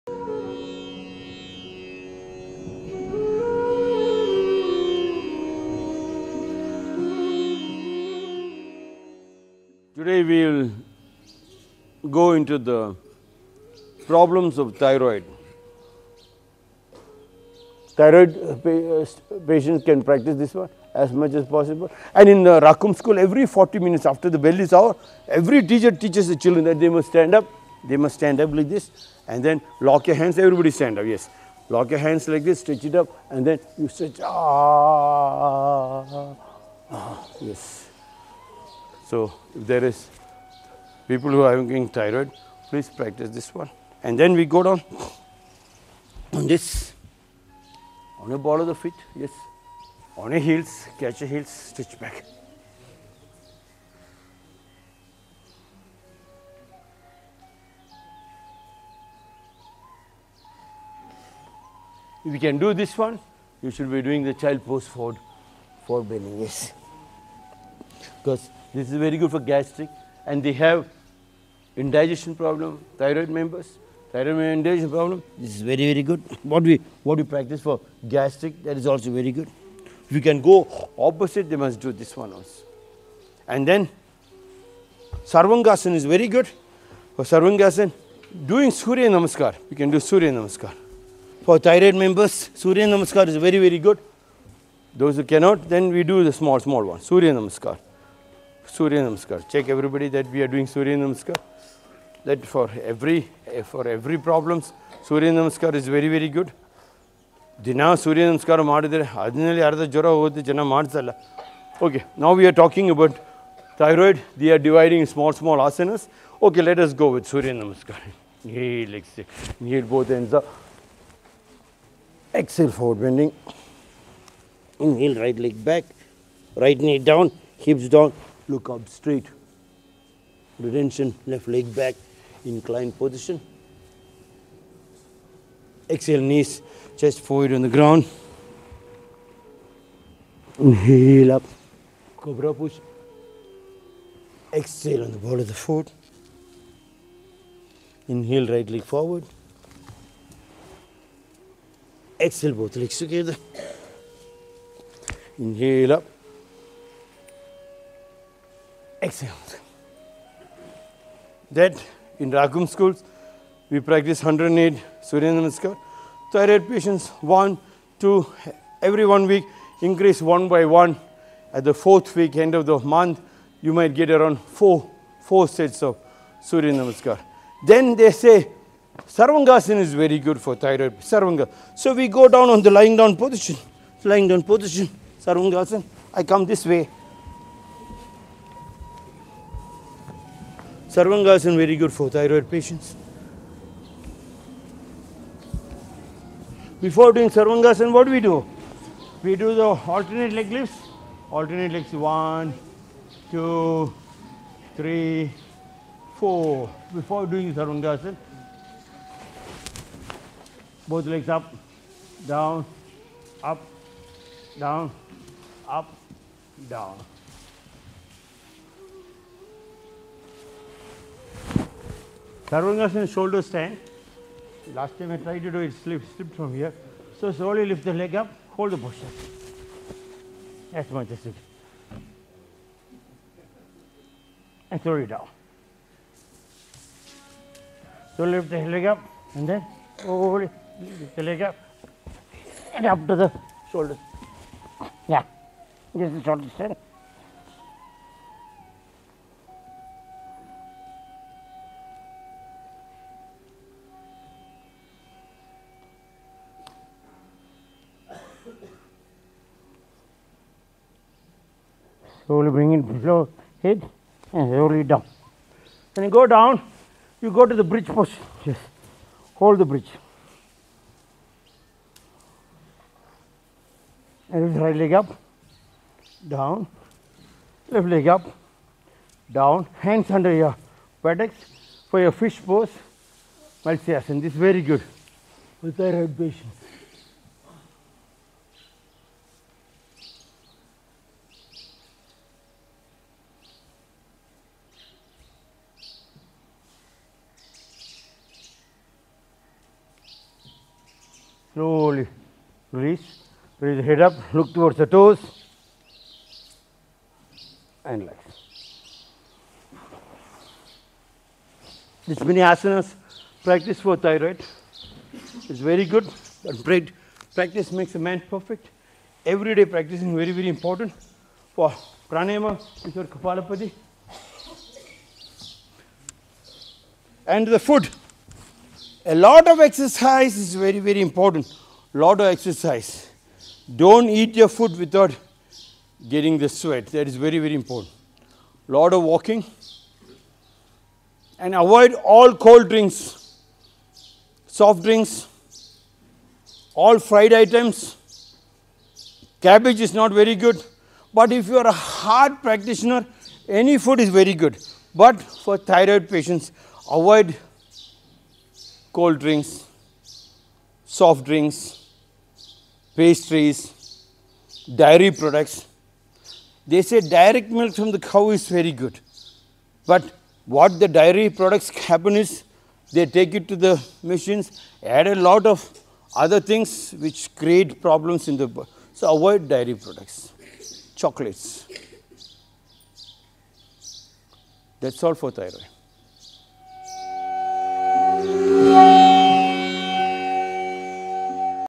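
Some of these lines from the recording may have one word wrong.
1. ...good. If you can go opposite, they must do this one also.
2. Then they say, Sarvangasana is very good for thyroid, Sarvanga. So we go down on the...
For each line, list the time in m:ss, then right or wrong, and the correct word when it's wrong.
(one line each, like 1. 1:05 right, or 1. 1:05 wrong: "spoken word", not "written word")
1. 1:19 right
2. 2:57 right.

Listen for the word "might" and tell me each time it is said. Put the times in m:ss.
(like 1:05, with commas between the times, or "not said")
2:53.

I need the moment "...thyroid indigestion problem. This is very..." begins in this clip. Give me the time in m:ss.
1:14.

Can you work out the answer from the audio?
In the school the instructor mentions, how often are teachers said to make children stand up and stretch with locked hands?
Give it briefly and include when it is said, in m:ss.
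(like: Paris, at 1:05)
every 40 minutes, at 0:23.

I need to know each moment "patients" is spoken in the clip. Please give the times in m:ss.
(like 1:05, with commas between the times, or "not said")
0:19, 2:46, 3:12, 5:56.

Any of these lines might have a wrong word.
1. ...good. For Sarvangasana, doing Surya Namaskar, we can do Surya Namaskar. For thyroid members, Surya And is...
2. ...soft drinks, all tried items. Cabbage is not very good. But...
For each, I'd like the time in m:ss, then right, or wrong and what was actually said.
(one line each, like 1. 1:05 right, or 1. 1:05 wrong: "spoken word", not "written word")
1. 1:26 wrong: "Namaskar", not "And"
2. 5:44 wrong: "fried", not "tried".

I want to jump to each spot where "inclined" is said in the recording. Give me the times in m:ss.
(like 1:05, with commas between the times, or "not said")
2:12.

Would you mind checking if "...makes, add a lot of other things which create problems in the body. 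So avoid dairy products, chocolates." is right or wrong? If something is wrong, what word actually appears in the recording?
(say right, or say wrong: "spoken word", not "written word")
wrong: "machines", not "makes".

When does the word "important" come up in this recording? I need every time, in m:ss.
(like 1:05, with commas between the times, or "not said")
5:20, 5:31, 5:37.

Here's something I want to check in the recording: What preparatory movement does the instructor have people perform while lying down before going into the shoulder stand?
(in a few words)
alternate leg lifts.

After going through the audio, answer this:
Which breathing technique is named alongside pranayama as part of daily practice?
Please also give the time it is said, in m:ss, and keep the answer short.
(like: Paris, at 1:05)
kapalabhati, at 5:23.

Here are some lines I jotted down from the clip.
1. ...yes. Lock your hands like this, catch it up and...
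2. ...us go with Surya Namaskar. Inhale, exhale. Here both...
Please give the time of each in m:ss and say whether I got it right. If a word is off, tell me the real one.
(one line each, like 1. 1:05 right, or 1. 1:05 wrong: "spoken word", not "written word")
1. 0:31 wrong: "stretch", not "catch"
2. 1:56 right.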